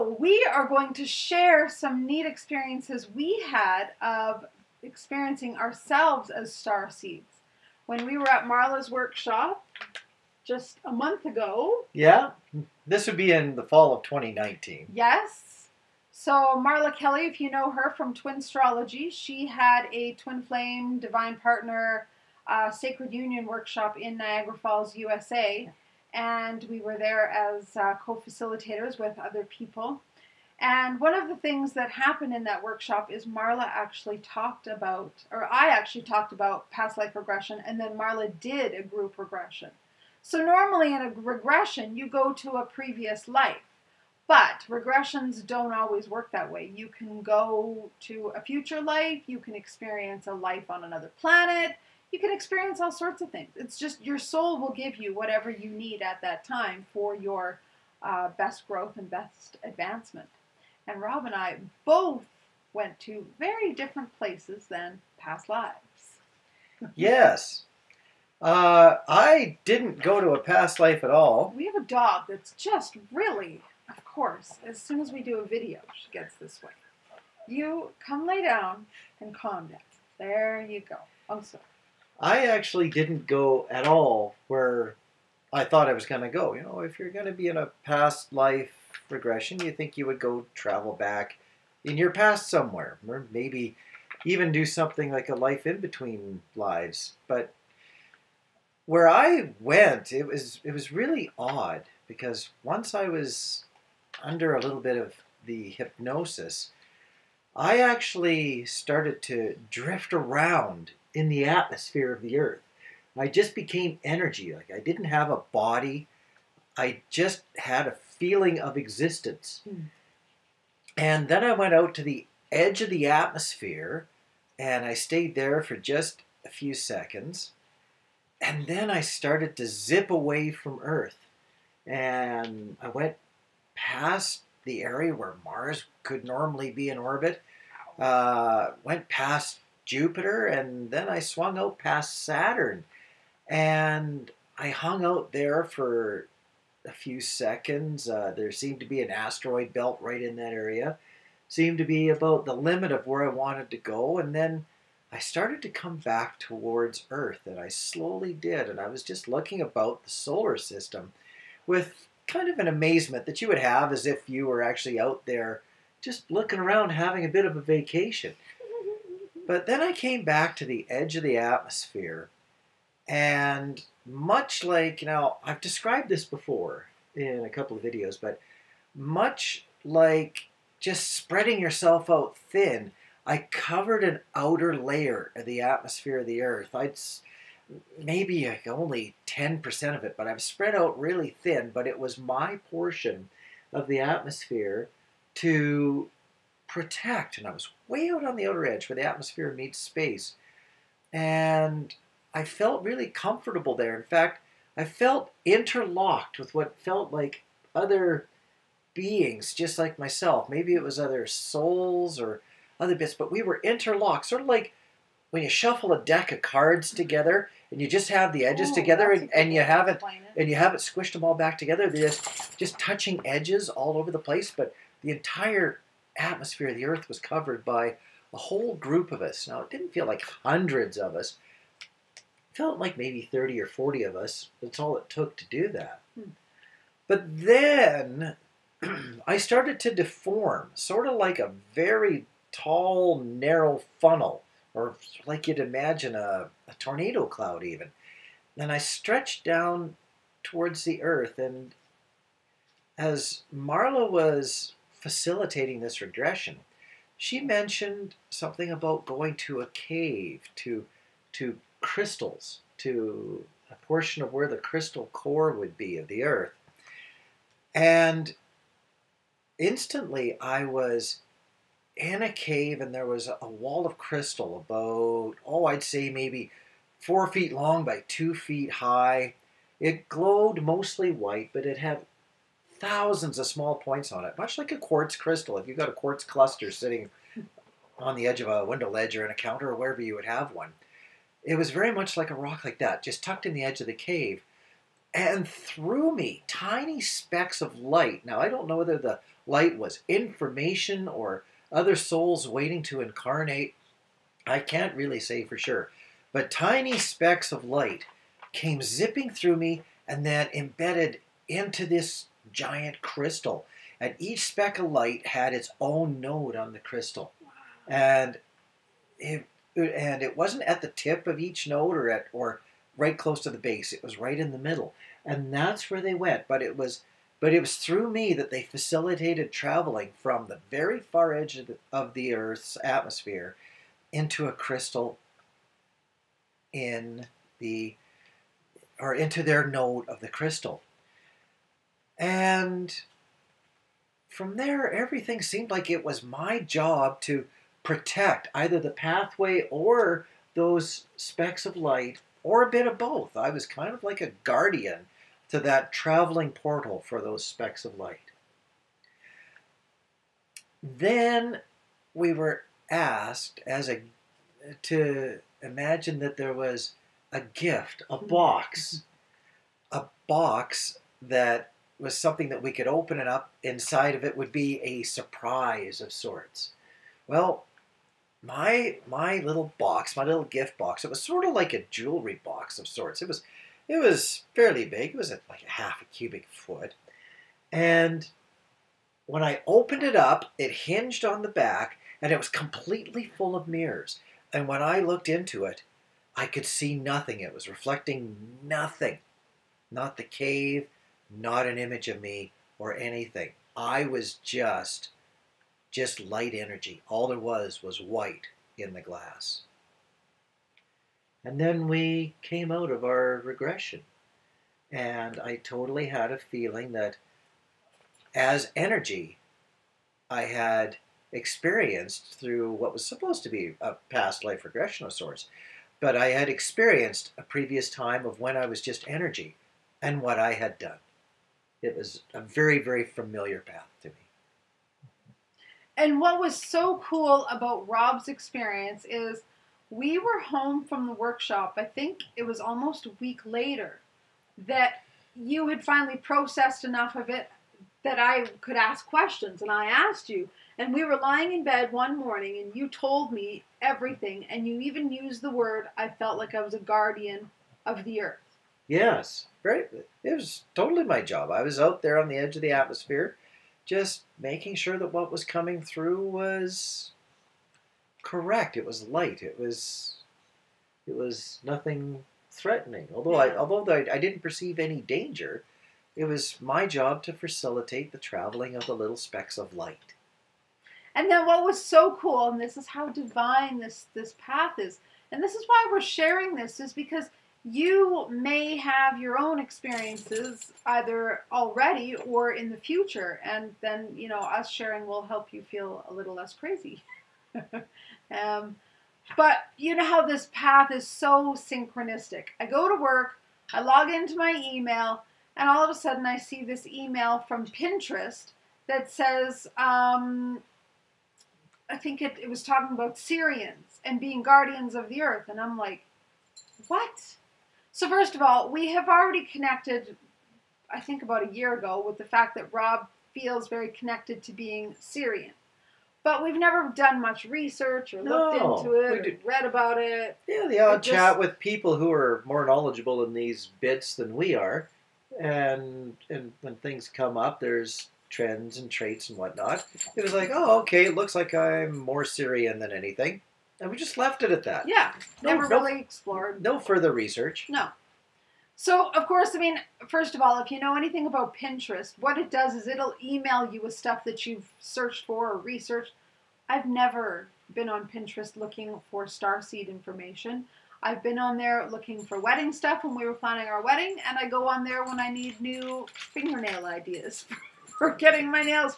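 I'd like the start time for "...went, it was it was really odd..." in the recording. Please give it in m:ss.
1:39.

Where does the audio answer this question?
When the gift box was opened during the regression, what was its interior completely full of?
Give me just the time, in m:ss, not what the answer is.
6:33.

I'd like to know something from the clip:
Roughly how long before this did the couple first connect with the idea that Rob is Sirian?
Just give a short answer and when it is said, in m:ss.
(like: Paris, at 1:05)
About a year ago, at 8:41.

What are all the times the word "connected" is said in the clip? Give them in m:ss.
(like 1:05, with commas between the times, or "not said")
8:39, 8:43.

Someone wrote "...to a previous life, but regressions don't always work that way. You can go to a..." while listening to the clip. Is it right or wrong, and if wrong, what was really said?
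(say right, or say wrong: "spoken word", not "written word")
right.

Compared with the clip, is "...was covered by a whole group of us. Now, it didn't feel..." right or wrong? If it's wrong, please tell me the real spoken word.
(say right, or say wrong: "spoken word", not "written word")
right.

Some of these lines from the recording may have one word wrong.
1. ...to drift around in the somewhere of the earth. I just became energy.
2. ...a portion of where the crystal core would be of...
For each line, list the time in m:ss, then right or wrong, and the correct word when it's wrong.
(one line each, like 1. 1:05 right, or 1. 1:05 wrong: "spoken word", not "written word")
1. 1:49 wrong: "atmosphere", not "somewhere"
2. 4:23 right.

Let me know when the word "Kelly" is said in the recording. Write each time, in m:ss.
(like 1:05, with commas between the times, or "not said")
0:16.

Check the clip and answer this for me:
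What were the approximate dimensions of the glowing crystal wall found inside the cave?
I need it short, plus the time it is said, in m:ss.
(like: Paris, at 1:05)
4 feet by 2 feet, at 4:36.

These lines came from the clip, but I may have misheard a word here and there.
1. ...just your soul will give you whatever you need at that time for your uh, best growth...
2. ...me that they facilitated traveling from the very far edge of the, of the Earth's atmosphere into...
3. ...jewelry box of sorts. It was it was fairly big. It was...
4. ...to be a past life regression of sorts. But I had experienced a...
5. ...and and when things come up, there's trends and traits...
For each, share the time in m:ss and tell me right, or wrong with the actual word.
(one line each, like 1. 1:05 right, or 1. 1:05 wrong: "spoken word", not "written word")
1. 0:53 right
2. 5:28 right
3. 6:21 right
4. 7:03 right
5. 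8:55 right.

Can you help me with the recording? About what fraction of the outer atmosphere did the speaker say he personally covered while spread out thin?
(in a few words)
10%.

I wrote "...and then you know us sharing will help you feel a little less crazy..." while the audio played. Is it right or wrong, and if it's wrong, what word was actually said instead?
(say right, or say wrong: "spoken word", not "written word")
right.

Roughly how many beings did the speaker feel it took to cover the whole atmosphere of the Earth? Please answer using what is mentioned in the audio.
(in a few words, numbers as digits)
30 or 40.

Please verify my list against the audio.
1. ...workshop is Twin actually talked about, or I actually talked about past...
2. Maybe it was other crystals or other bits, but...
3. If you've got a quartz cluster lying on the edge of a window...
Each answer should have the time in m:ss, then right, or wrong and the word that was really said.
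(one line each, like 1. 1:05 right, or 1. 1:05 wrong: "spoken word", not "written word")
1. 0:32 wrong: "Marla", not "Twin"
2. 3:30 wrong: "souls", not "crystals"
3. 4:45 wrong: "sitting", not "lying".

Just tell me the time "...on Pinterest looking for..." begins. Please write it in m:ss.
9:17.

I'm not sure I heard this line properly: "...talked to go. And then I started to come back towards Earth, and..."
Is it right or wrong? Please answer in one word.
wrong.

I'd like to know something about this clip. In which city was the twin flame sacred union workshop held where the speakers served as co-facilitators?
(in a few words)
Niagara Falls.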